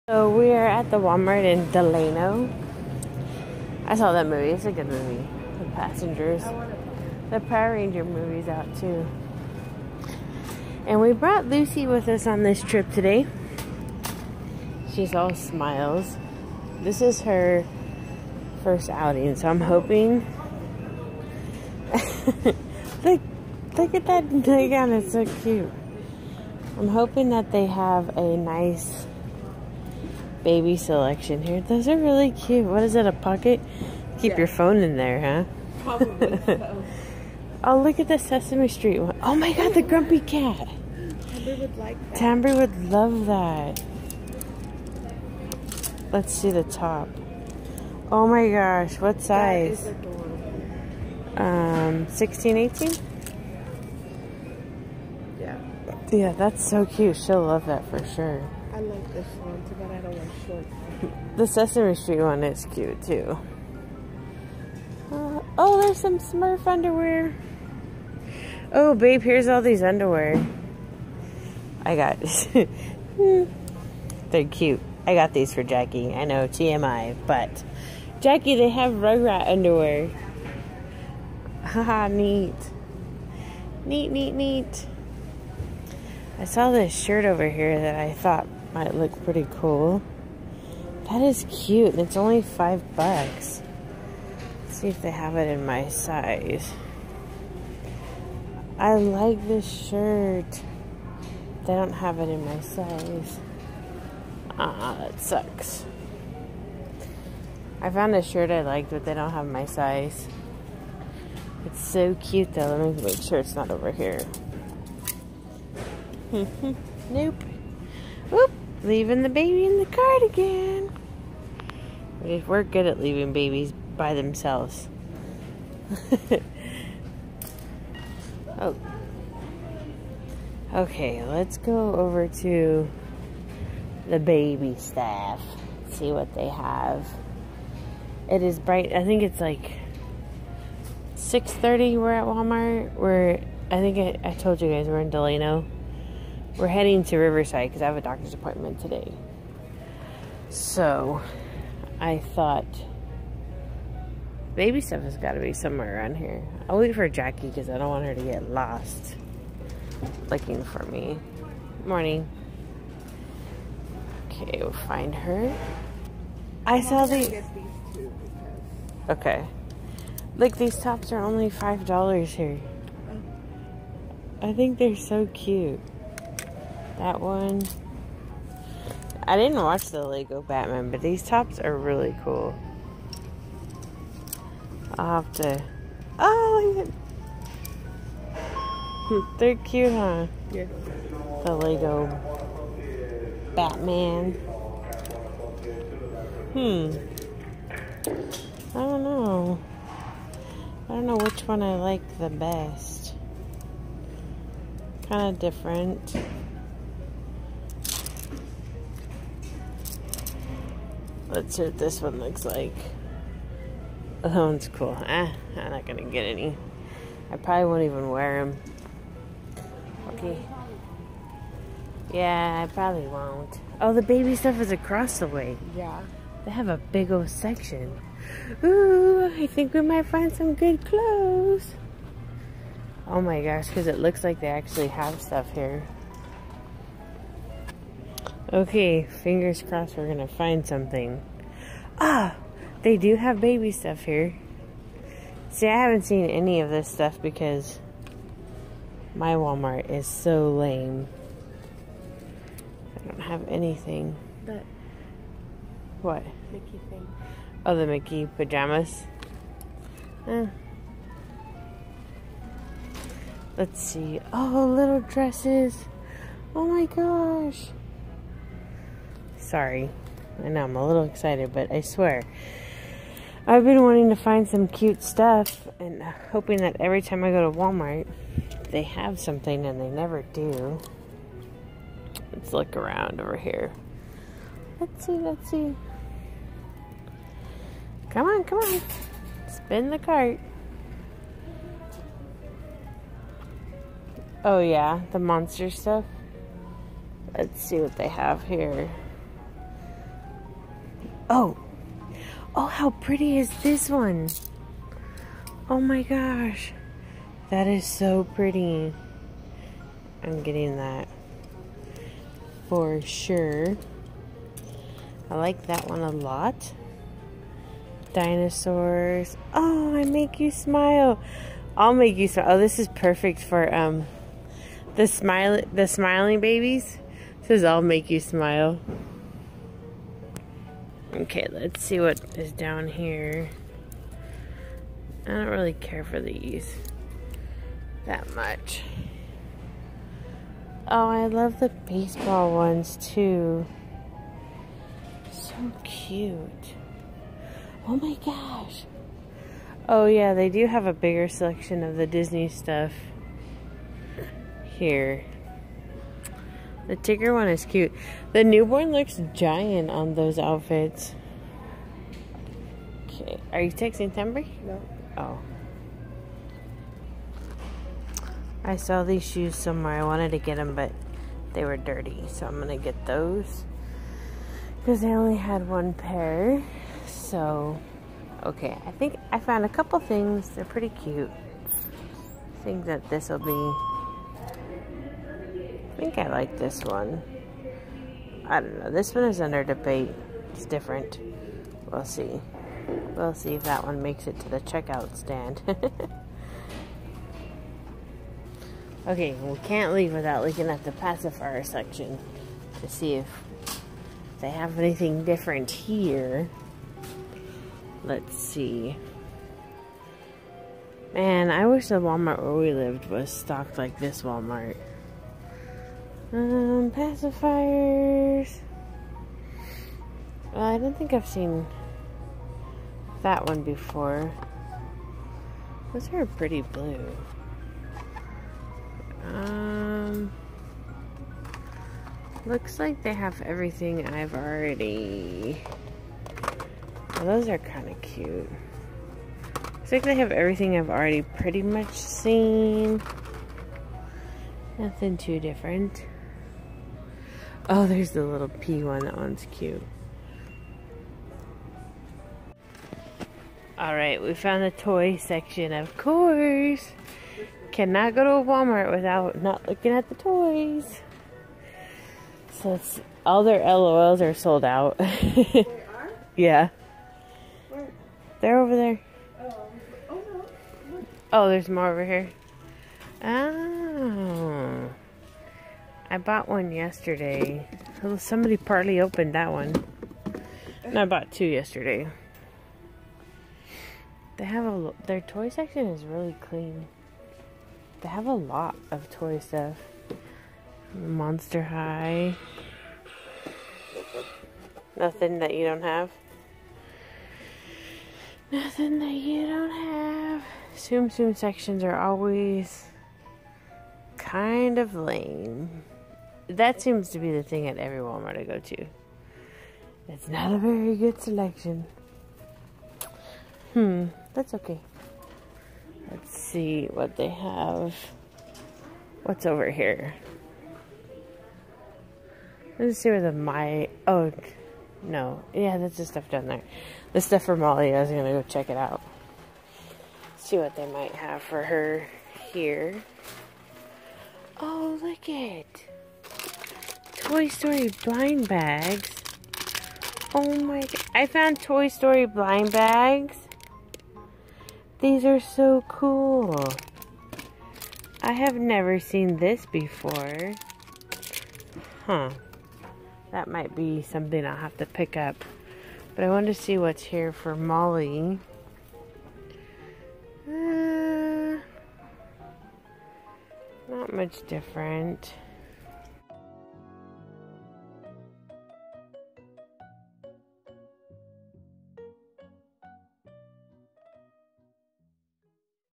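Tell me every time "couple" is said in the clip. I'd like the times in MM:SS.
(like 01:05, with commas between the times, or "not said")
06:19.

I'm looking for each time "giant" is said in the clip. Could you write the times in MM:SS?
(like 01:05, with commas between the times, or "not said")
05:59.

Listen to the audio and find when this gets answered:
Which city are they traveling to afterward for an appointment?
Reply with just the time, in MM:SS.
02:27.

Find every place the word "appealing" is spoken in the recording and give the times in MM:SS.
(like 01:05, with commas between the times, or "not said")
not said.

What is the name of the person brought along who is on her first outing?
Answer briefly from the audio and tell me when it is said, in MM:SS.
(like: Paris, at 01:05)
Lucy, at 00:11.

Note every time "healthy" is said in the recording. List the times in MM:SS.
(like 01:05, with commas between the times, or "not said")
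not said.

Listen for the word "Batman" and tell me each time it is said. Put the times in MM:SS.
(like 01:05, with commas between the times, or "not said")
03:00, 03:13.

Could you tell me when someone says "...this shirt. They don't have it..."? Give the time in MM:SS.
01:39.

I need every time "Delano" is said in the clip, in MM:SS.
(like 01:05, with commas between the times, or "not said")
00:01, 02:25.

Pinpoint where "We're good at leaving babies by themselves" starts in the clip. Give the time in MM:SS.
02:02.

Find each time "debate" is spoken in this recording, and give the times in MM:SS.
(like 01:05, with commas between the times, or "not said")
06:29.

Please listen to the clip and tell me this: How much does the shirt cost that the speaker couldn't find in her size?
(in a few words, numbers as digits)
$5.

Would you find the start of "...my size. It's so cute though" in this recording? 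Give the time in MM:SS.
01:49.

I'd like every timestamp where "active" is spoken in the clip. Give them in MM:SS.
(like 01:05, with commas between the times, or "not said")
not said.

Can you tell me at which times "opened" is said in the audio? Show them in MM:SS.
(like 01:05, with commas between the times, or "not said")
07:58.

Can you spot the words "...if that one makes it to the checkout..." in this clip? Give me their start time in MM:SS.
06:33.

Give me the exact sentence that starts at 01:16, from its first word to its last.
I know, TMI, but Jackie, they have Rugrat underwear.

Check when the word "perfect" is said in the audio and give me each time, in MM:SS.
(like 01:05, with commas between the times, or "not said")
05:22.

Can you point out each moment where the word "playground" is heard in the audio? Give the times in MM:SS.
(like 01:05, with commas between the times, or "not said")
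00:24.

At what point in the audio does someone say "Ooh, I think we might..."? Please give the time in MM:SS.
03:48.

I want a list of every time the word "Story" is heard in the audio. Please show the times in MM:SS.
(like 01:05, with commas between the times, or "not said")
08:57, 09:01.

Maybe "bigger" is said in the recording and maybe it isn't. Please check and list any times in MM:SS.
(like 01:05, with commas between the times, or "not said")
05:50.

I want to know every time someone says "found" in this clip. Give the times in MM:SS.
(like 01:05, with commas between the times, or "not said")
01:47, 06:19, 07:34, 09:01.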